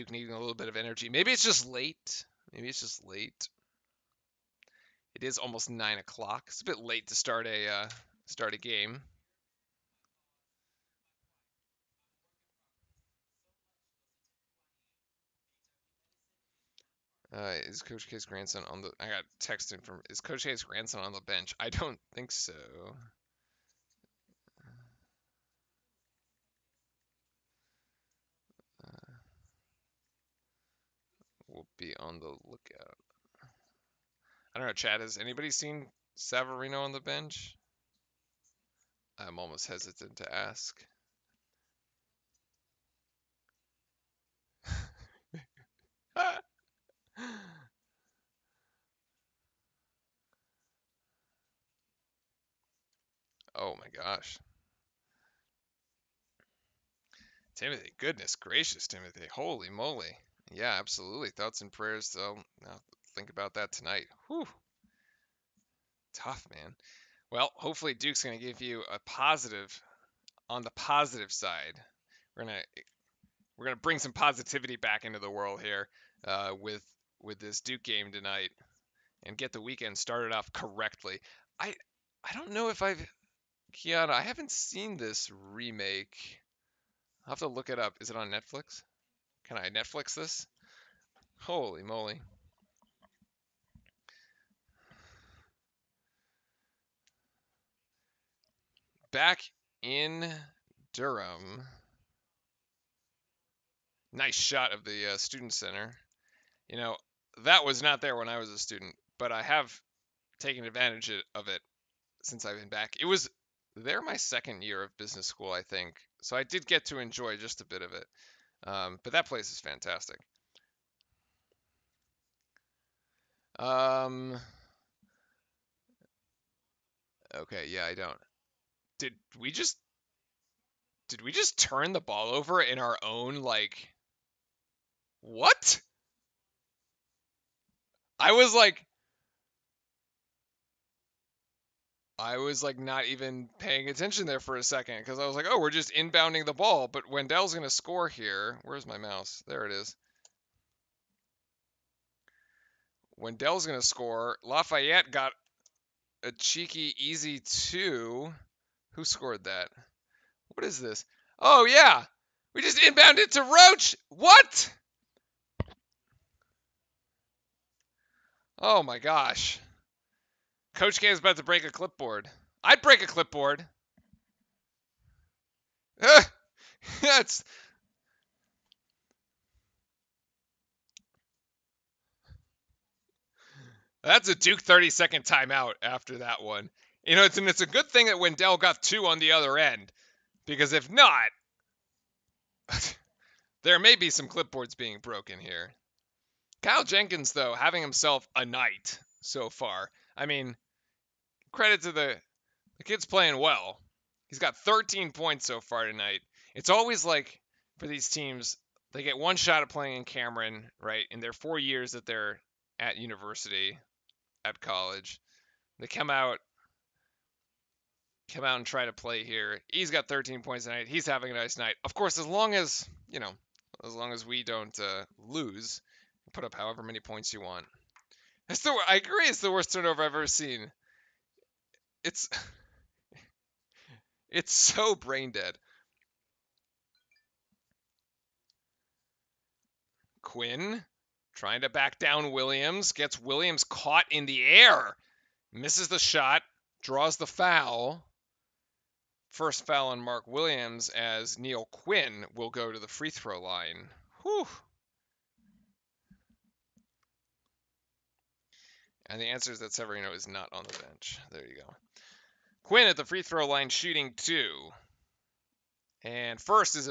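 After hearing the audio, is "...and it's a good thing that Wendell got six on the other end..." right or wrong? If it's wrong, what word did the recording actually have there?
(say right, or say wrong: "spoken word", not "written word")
wrong: "two", not "six".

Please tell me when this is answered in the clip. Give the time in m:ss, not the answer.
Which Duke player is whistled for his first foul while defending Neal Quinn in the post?
4:09.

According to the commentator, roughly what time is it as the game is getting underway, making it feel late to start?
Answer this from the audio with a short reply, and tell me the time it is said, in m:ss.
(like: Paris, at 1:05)
almost 9 o'clock, at 0:05.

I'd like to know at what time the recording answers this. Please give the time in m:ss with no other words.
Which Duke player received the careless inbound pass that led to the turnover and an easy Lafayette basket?
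2:43.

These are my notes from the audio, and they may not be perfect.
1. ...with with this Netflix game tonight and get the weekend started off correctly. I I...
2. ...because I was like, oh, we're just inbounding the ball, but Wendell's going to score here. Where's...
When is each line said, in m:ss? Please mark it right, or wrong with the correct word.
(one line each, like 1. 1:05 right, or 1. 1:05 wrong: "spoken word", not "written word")
1. 1:16 wrong: "Duke", not "Netflix"
2. 2:24 right.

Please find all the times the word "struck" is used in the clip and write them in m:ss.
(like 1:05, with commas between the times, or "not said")
not said.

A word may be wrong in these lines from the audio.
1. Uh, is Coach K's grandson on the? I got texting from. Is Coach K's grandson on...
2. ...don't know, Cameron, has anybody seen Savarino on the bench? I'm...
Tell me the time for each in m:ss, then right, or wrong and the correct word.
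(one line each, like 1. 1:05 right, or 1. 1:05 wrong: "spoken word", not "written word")
1. 0:17 right
2. 0:34 wrong: "Chad", not "Cameron".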